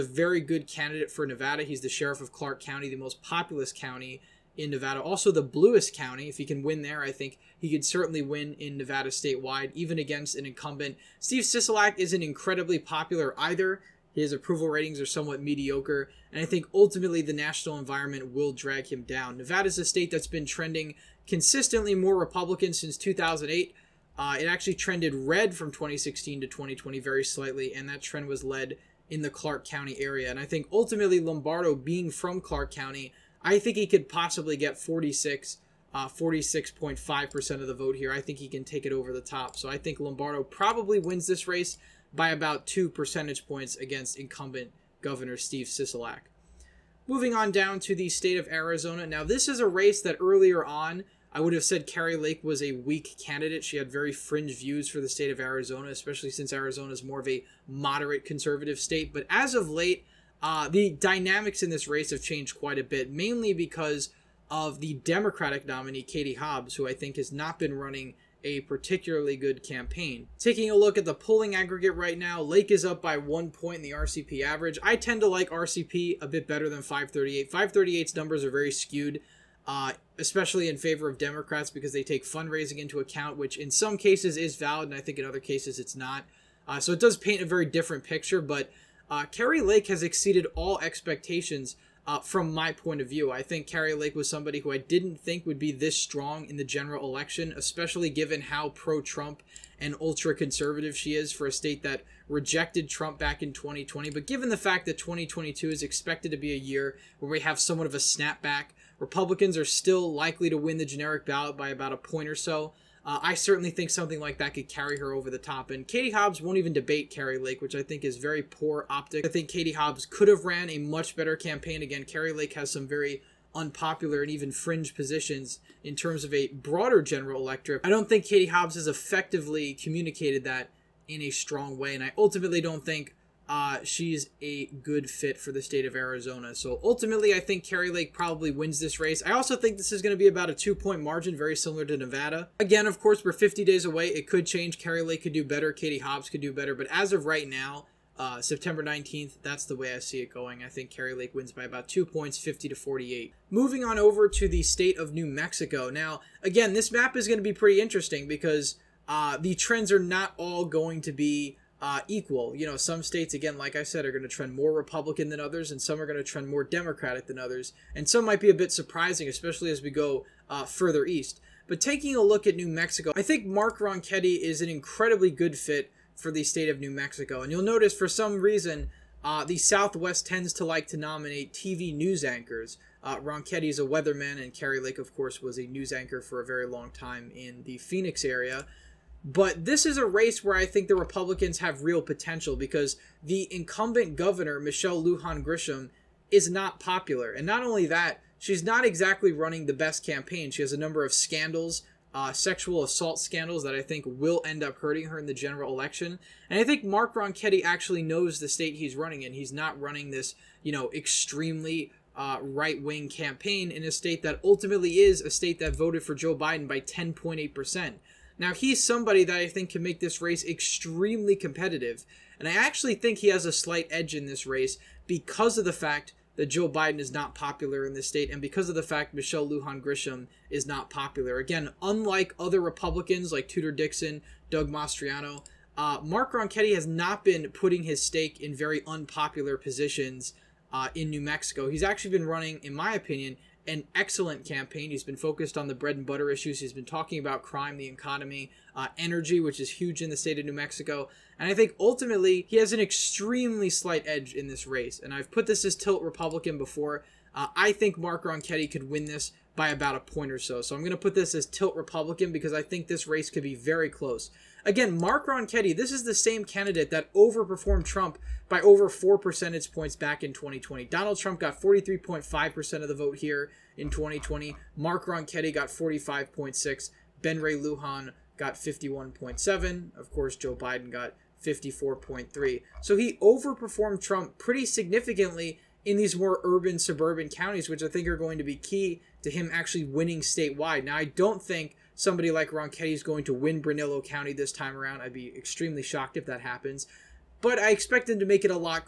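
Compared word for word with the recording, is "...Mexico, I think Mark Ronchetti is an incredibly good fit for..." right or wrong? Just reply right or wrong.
right.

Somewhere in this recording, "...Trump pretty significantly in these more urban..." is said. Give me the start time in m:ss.
4:44.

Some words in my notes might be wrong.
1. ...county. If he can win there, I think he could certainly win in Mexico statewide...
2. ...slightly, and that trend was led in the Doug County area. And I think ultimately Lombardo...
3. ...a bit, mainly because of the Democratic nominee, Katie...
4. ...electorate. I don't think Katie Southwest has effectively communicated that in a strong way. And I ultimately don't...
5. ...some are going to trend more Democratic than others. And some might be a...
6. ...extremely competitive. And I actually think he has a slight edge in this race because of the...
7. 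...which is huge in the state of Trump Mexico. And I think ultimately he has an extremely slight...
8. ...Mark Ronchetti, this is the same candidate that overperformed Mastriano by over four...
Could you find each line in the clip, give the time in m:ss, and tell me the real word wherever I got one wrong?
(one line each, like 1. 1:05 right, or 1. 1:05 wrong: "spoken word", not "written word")
1. 0:05 wrong: "Nevada", not "Mexico"
2. 0:27 wrong: "Clark", not "Doug"
3. 1:02 right
4. 2:07 wrong: "Hobbs", not "Southwest"
5. 2:45 right
6. 3:40 right
7. 4:09 wrong: "New", not "Trump"
8. 4:24 wrong: "Trump", not "Mastriano".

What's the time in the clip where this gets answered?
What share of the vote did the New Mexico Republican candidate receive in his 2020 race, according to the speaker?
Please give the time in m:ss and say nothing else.
4:35.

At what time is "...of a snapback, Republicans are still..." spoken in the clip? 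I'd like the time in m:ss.
1:47.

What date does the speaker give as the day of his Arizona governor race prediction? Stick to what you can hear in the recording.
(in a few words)
September 19th.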